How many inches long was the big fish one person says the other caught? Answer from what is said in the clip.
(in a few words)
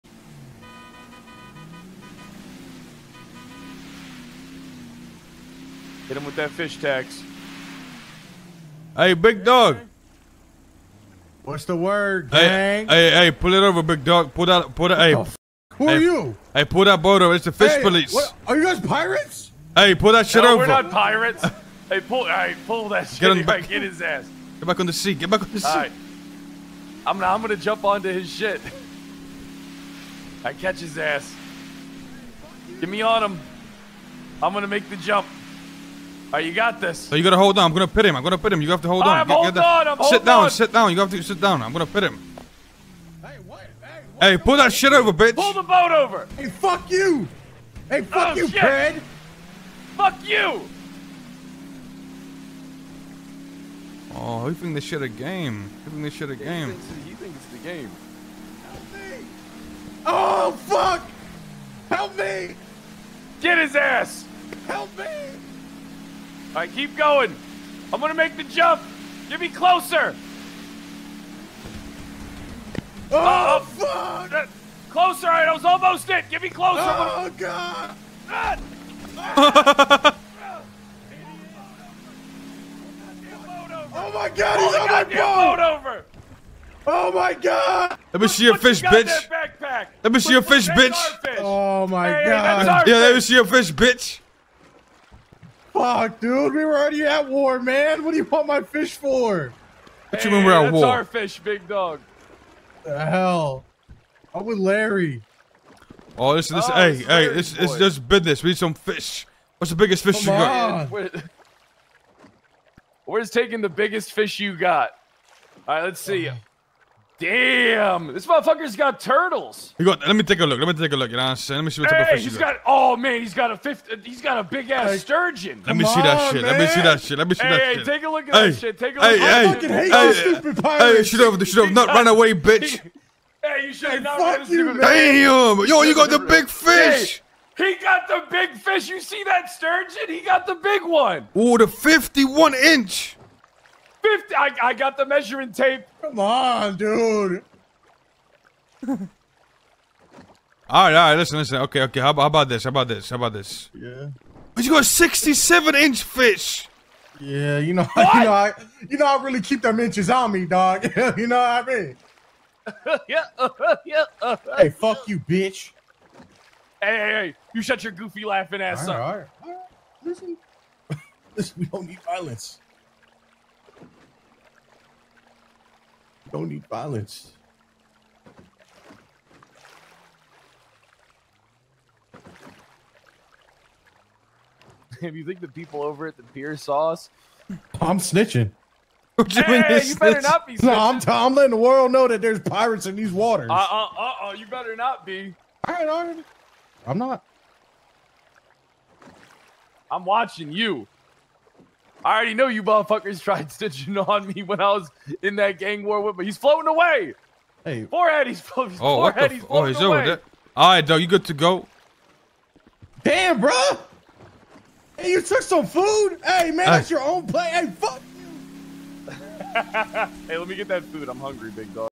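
67 inches.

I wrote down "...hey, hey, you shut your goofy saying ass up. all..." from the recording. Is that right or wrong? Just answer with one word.
wrong.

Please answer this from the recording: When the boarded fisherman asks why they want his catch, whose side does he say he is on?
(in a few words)
Larry.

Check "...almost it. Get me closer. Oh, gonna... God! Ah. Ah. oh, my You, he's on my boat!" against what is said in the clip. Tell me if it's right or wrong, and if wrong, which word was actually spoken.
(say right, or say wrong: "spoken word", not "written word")
wrong: "God", not "You".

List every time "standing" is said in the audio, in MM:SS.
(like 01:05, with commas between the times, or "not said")
not said.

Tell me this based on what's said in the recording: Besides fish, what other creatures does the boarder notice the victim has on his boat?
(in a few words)
Turtles.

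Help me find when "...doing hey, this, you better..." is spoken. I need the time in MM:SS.
03:09.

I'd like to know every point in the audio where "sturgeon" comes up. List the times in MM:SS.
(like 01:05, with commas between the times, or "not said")
02:04, 02:19.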